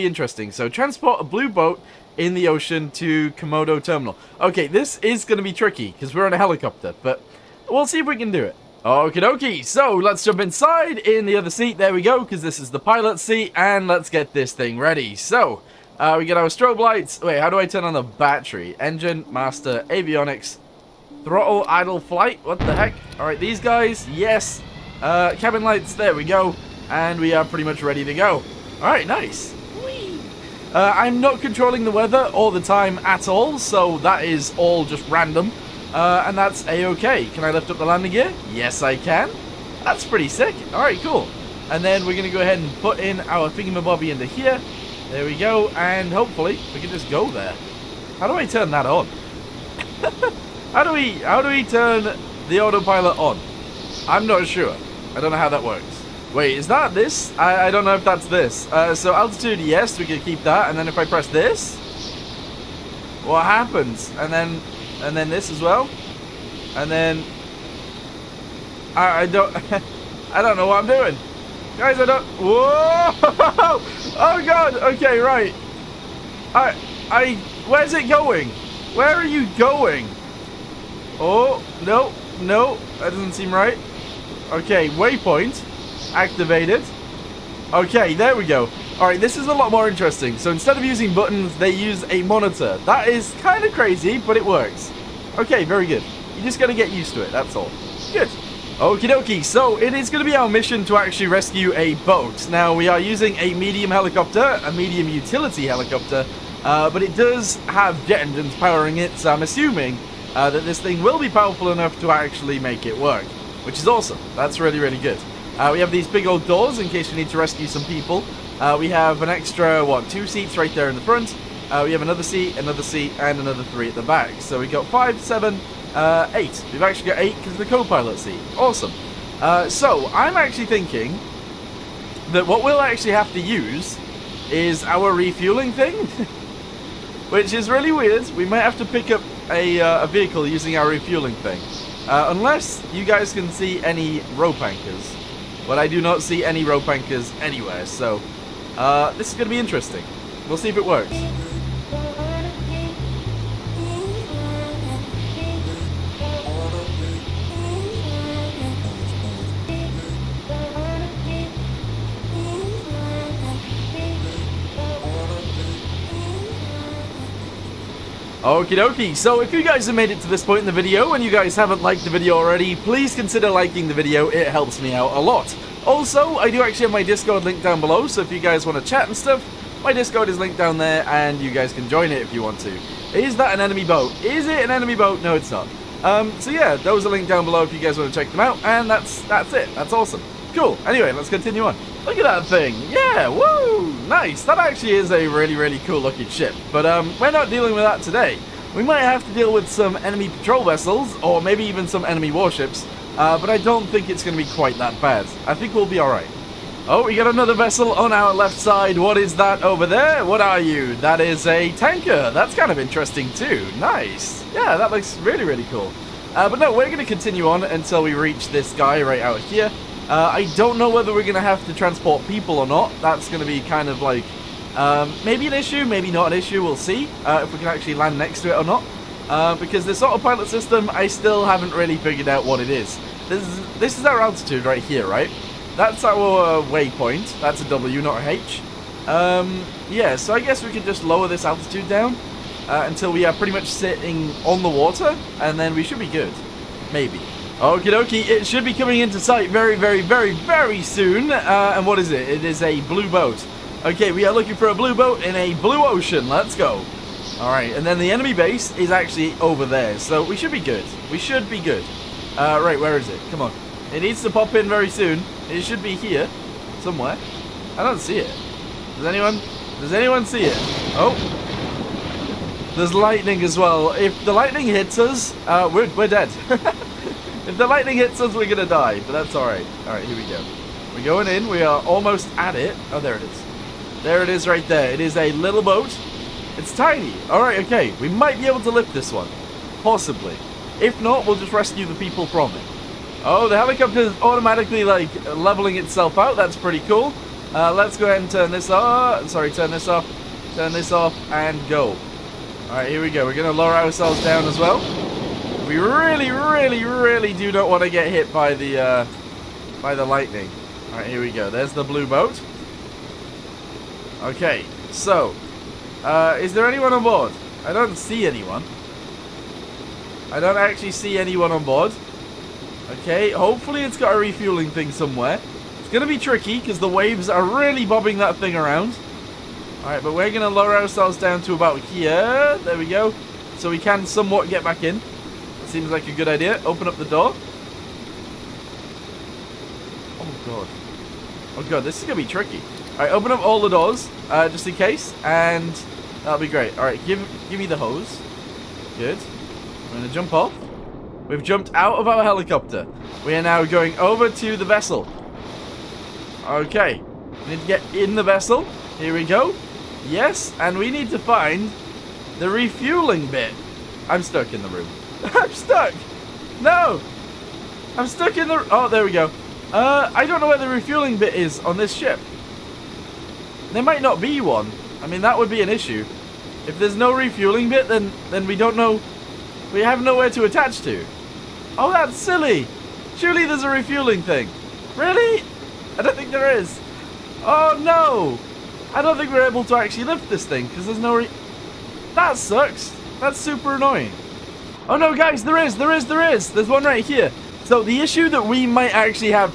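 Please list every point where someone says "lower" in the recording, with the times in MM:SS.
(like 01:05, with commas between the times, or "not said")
04:01, 05:03, 05:30.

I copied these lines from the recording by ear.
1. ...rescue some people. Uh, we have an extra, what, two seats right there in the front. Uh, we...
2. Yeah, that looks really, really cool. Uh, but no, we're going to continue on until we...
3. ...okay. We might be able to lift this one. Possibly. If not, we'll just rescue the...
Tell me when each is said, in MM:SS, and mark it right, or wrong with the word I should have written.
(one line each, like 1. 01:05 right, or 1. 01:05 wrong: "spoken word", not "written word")
1. 01:57 right
2. 03:34 right
3. 04:47 right.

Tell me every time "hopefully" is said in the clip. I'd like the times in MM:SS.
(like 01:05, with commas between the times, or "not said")
00:46, 05:23.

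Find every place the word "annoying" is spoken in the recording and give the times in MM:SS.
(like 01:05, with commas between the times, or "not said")
06:33.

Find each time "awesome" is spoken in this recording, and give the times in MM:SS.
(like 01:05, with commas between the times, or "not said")
01:53, 02:08, 03:09.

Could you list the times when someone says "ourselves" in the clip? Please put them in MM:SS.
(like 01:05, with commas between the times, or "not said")
05:03, 05:30.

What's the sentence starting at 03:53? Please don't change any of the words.
This is, this is our altitude right here, right?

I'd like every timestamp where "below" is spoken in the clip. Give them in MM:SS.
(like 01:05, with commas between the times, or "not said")
02:57, 03:07.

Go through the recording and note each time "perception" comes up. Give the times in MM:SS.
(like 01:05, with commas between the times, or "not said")
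not said.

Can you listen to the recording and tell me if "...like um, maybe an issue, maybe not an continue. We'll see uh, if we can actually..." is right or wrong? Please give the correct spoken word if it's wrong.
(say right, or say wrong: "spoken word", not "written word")
wrong: "issue", not "continue".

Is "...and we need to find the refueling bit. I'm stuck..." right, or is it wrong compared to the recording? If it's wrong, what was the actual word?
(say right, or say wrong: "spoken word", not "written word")
right.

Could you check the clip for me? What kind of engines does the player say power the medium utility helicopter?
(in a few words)
jet engines.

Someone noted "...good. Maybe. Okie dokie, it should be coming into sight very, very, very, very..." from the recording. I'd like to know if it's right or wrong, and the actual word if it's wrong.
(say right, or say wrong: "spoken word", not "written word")
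right.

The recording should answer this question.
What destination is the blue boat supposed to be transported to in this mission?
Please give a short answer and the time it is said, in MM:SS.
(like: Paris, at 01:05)
Komodo Terminal, at 00:03.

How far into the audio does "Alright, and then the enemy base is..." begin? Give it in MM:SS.
04:17.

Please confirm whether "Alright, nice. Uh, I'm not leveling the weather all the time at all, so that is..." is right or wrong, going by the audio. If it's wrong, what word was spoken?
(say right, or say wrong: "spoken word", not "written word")
wrong: "controlling", not "leveling".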